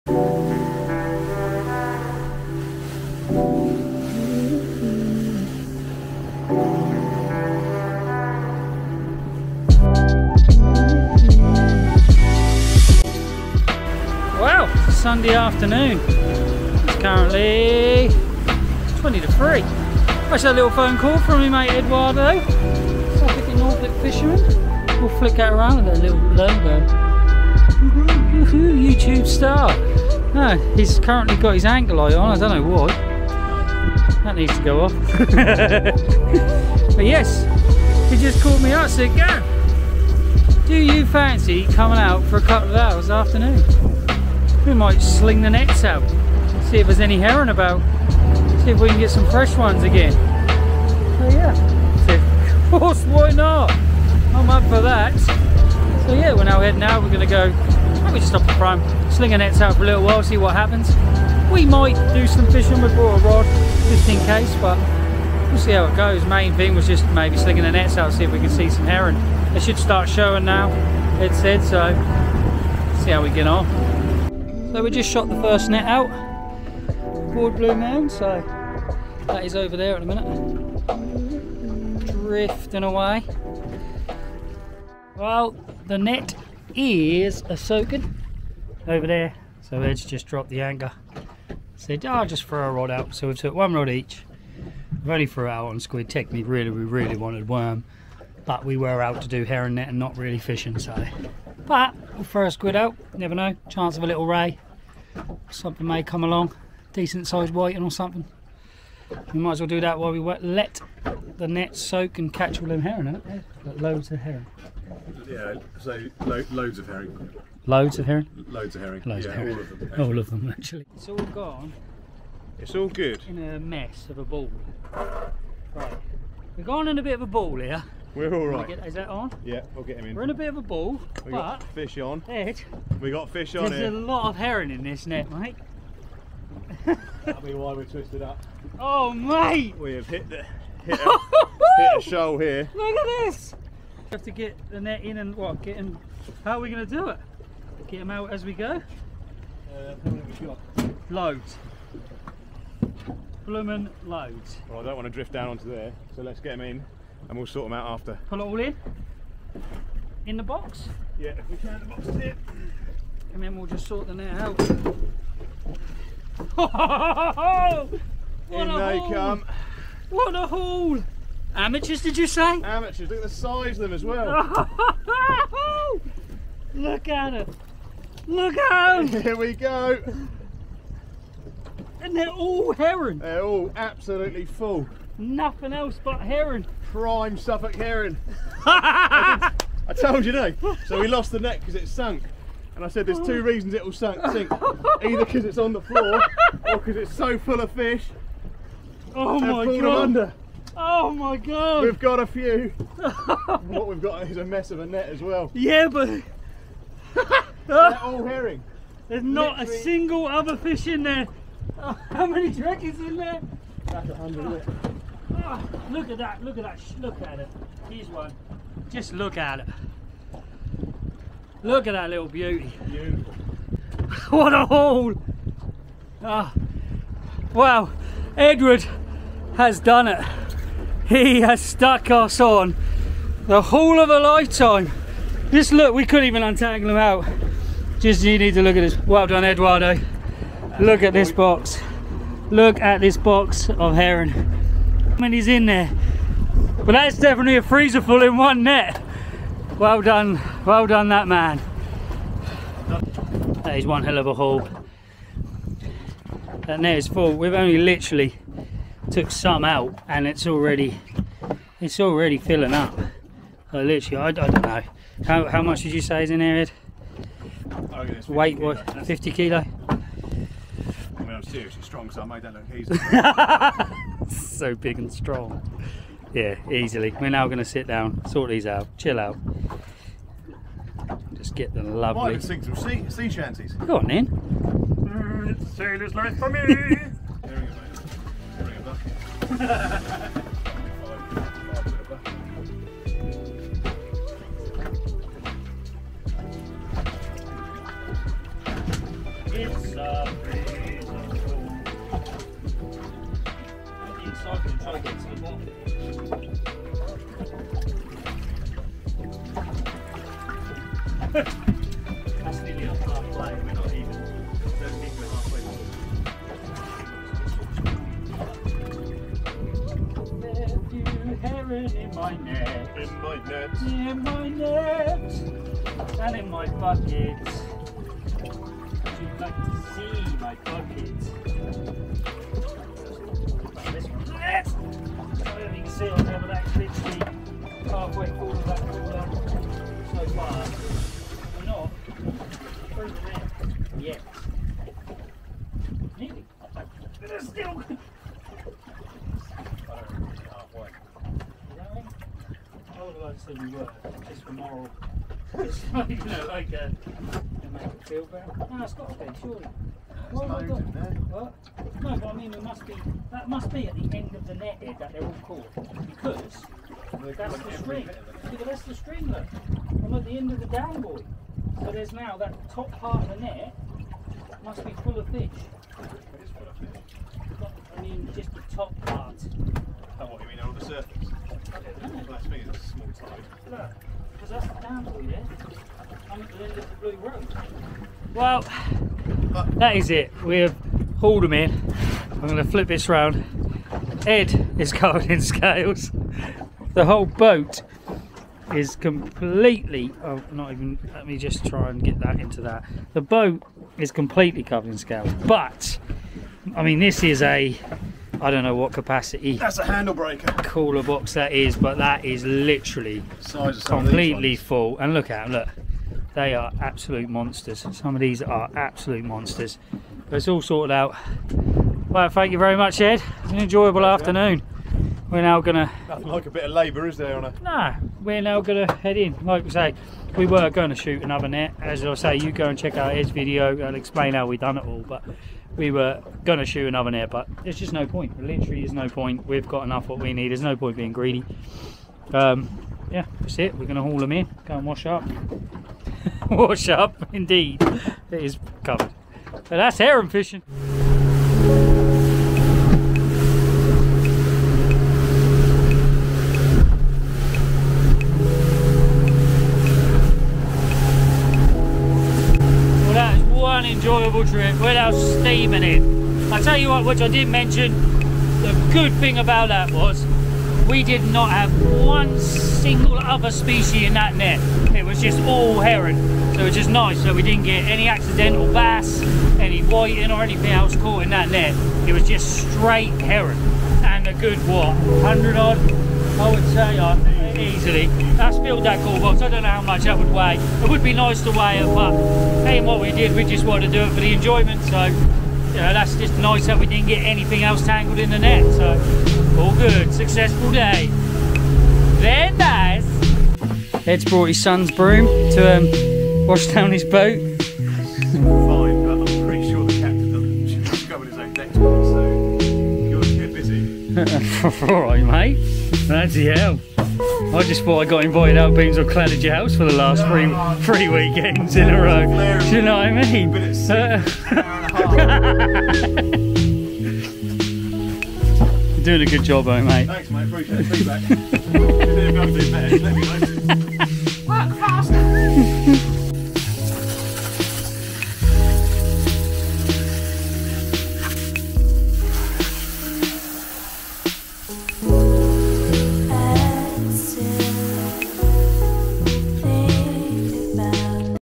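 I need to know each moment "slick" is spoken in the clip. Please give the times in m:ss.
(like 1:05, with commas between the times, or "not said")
not said.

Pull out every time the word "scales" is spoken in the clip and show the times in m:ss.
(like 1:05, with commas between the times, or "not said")
6:35, 6:44.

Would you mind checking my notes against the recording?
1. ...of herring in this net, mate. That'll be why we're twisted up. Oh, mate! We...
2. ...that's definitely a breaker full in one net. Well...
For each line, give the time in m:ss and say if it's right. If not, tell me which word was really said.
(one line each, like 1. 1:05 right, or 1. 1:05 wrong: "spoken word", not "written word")
1. 2:14 right
2. 4:06 wrong: "freezer", not "breaker".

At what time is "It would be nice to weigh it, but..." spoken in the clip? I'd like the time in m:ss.
8:10.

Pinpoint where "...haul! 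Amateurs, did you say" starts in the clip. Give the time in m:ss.
2:50.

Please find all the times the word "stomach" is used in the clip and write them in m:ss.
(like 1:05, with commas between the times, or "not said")
not said.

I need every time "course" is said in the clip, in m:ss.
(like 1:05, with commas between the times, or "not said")
0:52.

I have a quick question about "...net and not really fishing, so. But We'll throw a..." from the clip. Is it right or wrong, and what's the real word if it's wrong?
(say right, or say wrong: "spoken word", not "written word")
right.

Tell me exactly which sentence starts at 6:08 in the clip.
See the rest of the string, look.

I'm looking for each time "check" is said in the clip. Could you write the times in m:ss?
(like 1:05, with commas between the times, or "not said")
7:12.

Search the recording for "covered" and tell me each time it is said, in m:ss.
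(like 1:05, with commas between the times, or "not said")
6:34, 6:44, 7:28.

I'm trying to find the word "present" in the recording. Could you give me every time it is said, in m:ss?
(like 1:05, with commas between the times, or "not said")
not said.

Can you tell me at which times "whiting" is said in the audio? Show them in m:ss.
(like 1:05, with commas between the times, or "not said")
1:47, 7:59.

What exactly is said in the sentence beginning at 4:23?
So literally, I, I don't know.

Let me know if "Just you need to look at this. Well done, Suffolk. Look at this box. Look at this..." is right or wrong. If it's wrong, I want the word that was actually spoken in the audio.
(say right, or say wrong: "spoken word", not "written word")
wrong: "Eduardo", not "Suffolk".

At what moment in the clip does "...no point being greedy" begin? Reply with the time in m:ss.
7:20.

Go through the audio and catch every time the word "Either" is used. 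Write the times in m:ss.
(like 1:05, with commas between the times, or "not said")
3:15.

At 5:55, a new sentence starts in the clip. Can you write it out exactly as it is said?
It's you know, like, uh, make it feel better.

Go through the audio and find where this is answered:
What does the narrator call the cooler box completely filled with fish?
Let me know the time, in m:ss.
6:49.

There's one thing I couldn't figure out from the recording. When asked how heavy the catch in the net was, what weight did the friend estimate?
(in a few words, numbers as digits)
50 kilo.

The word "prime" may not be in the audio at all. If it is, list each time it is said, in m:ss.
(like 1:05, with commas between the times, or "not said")
0:58, 3:06.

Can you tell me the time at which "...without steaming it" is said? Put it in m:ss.
7:44.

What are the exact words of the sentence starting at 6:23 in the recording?
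Look, because that's the dan buoy there.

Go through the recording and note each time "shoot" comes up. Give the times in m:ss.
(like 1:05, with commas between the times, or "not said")
7:10, 7:16.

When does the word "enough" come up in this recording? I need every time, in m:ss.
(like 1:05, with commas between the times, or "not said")
7:19.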